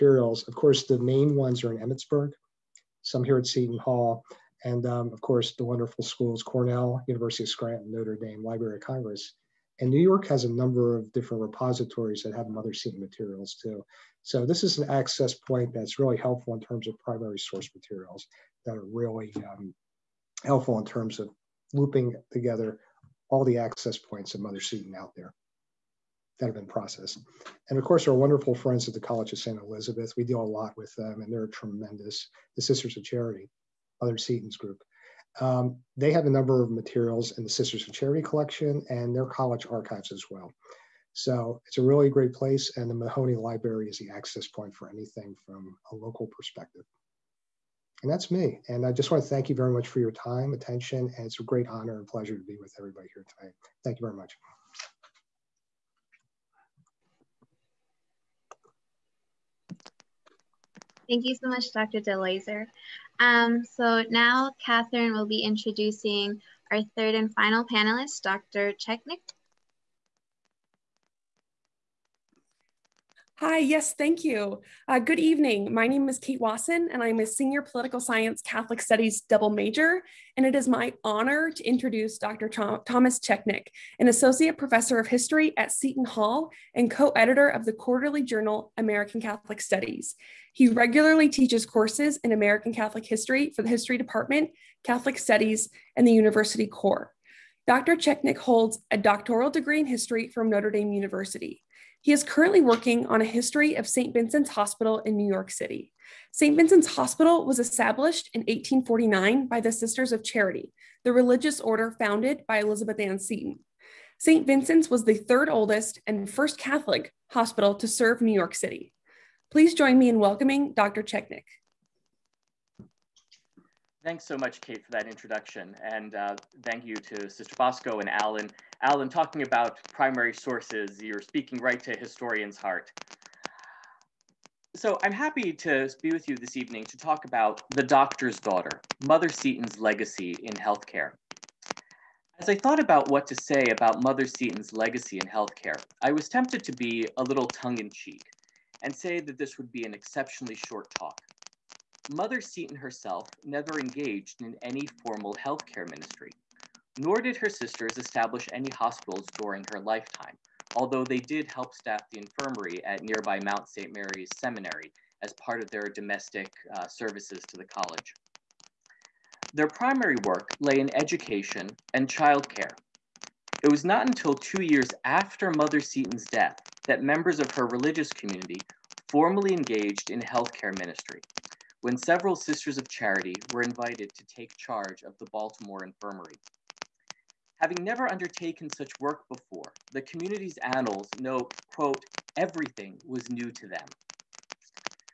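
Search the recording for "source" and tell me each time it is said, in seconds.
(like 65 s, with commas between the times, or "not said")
17 s, 130 s.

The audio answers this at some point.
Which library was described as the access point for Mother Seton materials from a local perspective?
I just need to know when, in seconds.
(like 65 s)
42 s.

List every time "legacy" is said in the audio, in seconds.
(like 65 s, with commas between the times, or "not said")
139 s, 144 s.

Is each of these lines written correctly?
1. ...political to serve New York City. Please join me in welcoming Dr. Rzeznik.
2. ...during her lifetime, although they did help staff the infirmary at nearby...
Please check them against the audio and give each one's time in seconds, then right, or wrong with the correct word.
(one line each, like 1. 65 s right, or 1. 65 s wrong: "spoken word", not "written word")
1. 117 s wrong: "hospital", not "political"
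2. 159 s right.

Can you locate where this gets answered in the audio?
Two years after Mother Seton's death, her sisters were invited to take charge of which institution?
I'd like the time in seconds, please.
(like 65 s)
185 s.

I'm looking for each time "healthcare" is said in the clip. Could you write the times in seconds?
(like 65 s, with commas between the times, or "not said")
140 s, 145 s, 155 s, 180 s.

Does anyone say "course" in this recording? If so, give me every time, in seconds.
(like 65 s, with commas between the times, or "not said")
0 s, 5 s, 27 s, 91 s.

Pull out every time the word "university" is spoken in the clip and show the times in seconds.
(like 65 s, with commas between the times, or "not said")
7 s, 96 s, 100 s.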